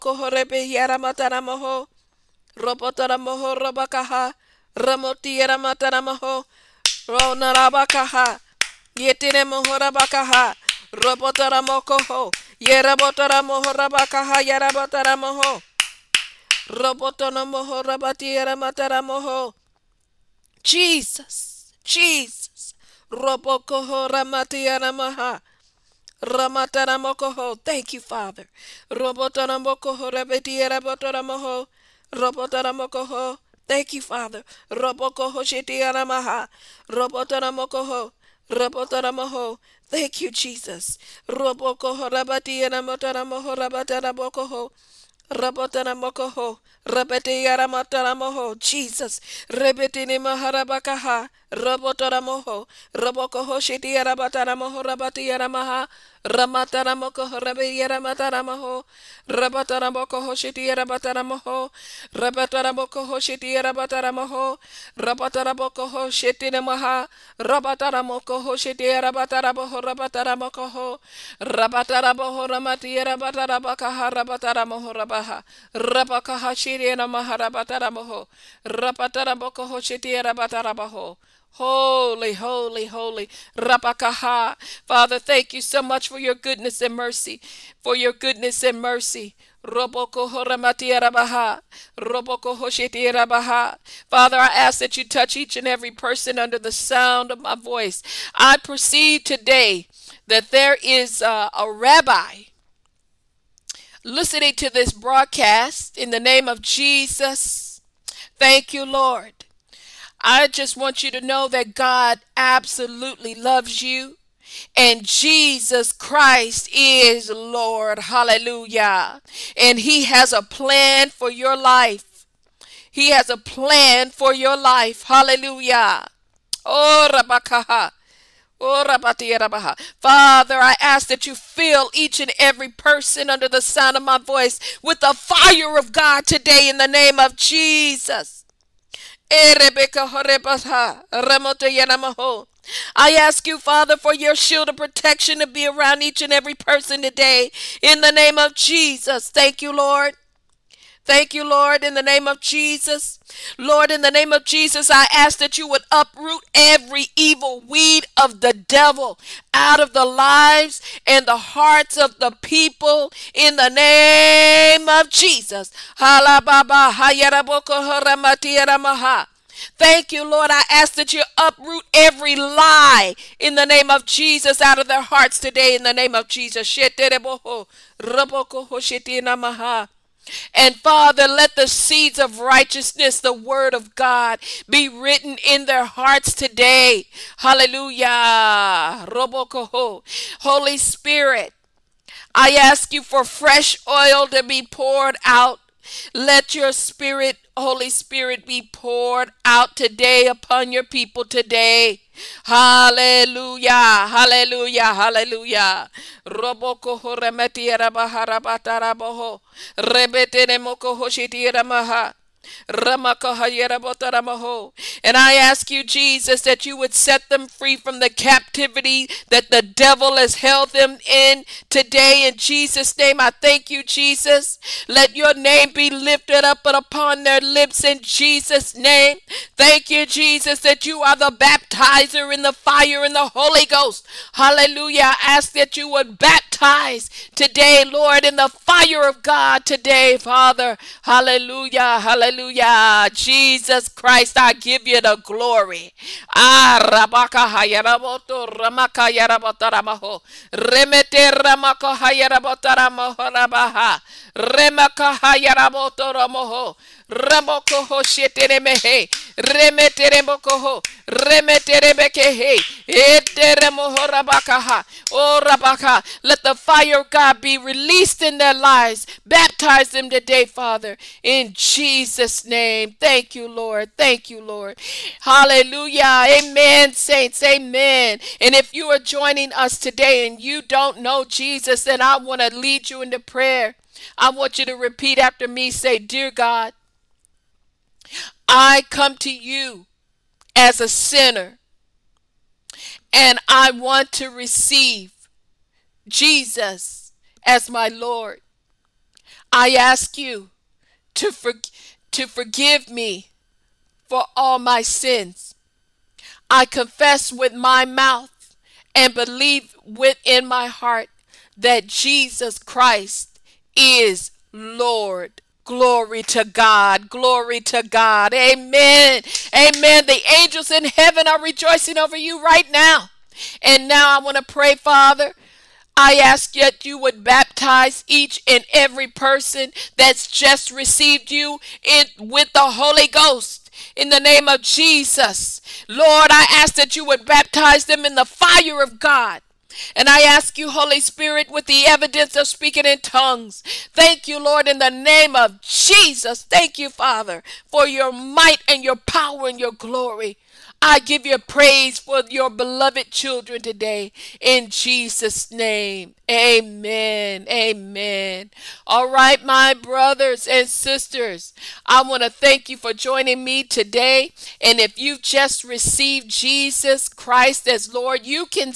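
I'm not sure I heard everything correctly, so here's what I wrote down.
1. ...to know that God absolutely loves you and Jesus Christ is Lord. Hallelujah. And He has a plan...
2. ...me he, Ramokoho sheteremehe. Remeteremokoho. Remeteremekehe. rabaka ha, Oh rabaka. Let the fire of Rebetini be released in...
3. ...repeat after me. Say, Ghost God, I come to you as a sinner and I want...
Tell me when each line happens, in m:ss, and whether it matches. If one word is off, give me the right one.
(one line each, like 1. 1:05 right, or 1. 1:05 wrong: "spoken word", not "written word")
1. 1:51 right
2. 4:17 wrong: "God", not "Rebetini"
3. 4:44 wrong: "Dear", not "Ghost".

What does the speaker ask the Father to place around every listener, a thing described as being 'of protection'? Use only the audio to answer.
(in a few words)
shield.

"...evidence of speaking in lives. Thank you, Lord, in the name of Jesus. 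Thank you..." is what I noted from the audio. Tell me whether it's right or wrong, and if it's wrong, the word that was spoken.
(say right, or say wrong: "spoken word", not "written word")
wrong: "tongues", not "lives".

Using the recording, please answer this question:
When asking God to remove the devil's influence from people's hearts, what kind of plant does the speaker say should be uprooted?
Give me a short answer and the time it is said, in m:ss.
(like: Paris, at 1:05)
evil weed, at 2:37.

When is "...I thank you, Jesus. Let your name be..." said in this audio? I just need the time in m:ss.
3:43.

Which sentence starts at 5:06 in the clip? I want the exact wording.
I confess with my mouth and believe within my heart that Jesus Christ is Lord.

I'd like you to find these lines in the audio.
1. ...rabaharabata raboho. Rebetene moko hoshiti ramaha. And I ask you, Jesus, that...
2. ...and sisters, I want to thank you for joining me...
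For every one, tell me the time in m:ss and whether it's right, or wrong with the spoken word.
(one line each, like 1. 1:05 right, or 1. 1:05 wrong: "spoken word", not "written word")
1. 3:27 right
2. 6:00 right.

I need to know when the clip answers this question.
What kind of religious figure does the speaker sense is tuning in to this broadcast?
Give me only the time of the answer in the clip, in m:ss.
1:41.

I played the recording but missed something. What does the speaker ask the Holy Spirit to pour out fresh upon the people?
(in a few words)
oil.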